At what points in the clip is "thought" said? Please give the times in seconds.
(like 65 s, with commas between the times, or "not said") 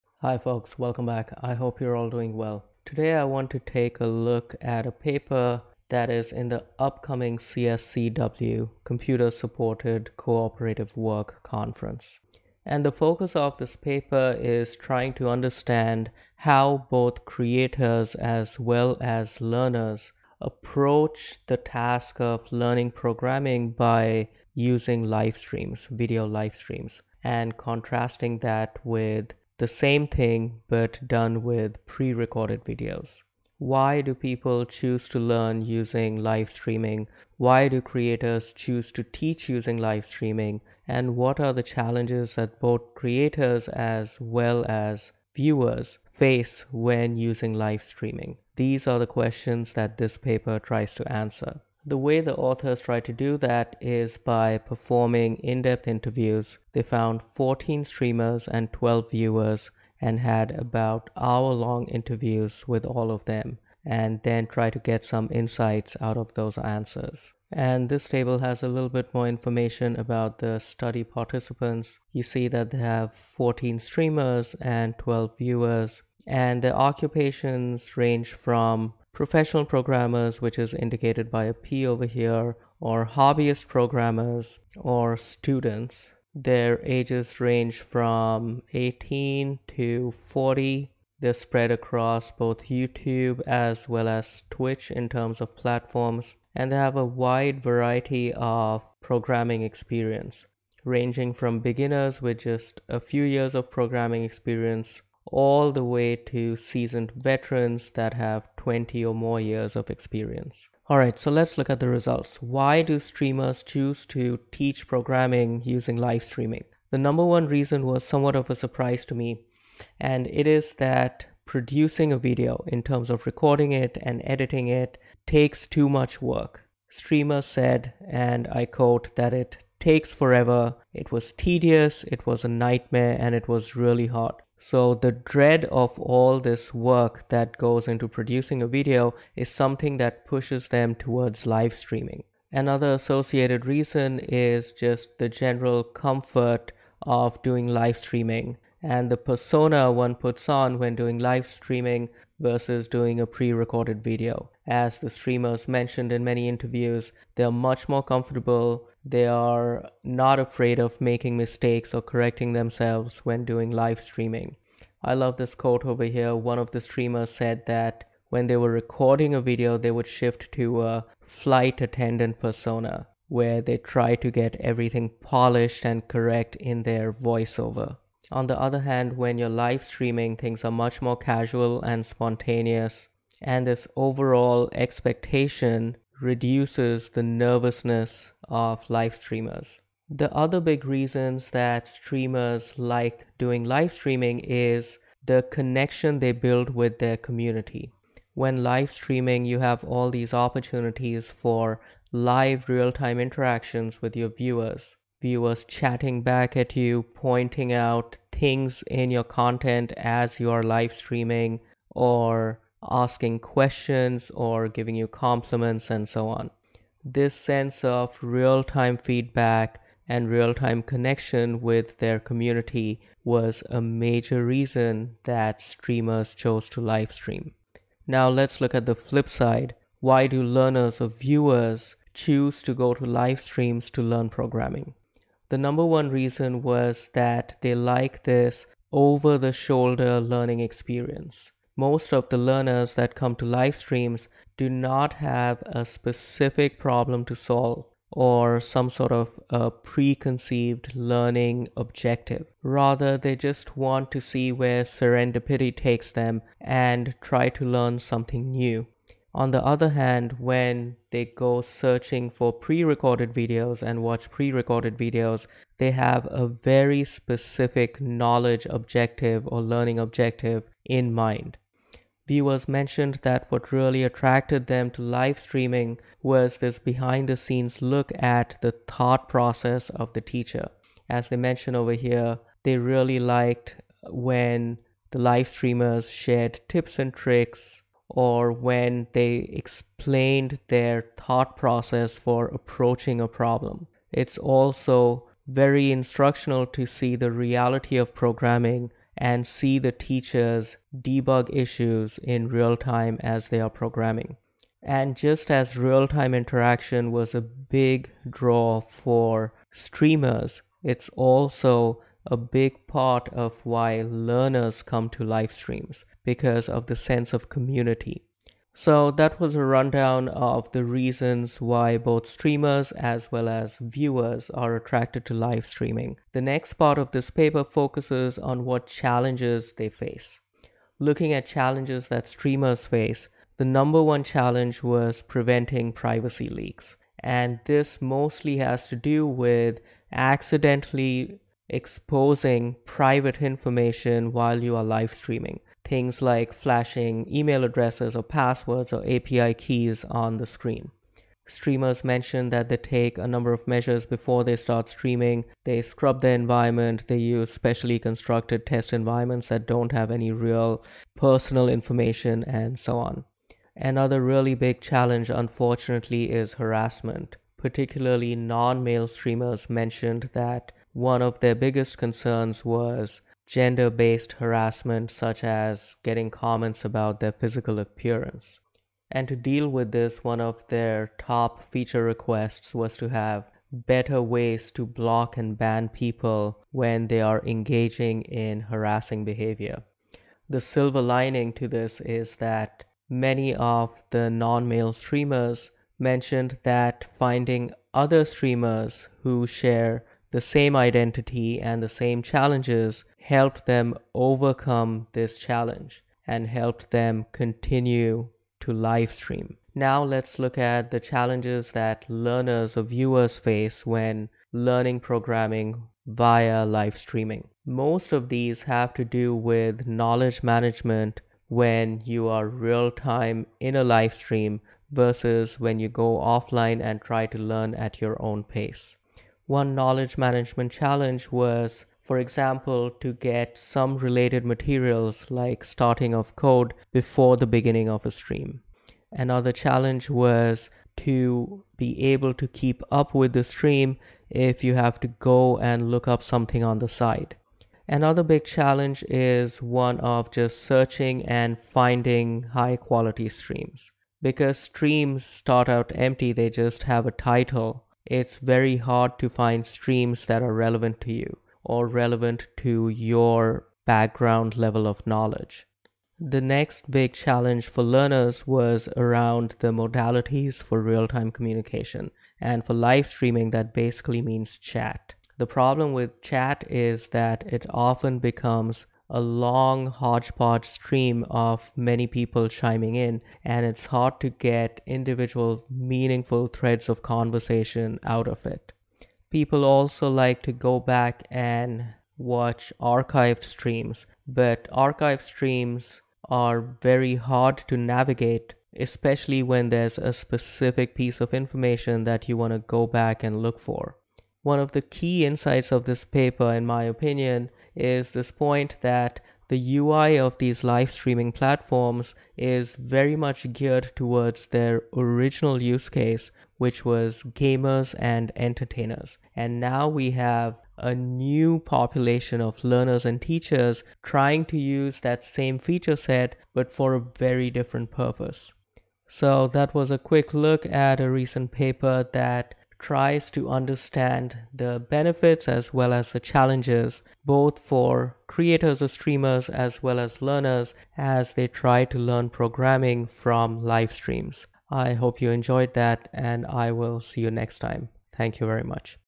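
278 s, 291 s.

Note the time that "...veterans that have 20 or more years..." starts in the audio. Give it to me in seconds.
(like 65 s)
107 s.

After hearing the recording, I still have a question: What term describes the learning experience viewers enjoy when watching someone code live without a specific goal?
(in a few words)
over the shoulder.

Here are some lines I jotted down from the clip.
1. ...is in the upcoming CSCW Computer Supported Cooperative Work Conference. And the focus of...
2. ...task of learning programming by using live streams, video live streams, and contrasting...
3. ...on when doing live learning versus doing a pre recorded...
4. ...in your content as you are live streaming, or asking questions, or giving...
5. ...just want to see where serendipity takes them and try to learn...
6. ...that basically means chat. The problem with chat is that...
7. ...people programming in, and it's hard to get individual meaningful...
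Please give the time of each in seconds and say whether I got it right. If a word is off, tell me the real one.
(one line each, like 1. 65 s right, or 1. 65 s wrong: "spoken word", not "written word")
1. 6 s right
2. 21 s right
3. 150 s wrong: "streaming", not "learning"
4. 208 s right
5. 253 s right
6. 473 s right
7. 482 s wrong: "chiming", not "programming".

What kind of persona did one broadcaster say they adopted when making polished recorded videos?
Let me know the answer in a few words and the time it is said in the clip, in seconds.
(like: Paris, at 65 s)
flight attendant persona, at 171 s.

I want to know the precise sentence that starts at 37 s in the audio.
Why do creators choose to teach using live streaming?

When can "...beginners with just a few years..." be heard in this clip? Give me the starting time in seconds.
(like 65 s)
101 s.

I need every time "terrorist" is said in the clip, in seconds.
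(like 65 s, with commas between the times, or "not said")
not said.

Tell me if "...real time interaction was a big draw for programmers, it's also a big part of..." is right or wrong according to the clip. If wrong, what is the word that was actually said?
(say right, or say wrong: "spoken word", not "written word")
wrong: "streamers", not "programmers".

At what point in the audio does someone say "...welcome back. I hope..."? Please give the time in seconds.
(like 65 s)
0 s.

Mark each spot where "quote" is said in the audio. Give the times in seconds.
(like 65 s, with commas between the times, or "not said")
128 s, 165 s.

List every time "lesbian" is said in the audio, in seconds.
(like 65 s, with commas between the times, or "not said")
not said.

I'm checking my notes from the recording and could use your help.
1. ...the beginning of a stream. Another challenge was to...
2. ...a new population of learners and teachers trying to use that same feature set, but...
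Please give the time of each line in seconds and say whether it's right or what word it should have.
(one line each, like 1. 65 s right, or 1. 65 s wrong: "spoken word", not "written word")
1. 437 s right
2. 520 s right.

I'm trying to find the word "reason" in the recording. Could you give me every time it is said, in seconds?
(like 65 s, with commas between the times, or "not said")
117 s, 143 s, 190 s, 224 s, 236 s, 320 s.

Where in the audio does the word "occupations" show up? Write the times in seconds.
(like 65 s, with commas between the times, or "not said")
76 s.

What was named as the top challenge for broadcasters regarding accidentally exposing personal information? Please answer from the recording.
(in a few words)
preventing privacy leaks.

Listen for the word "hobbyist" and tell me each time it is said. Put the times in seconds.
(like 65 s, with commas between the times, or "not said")
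83 s.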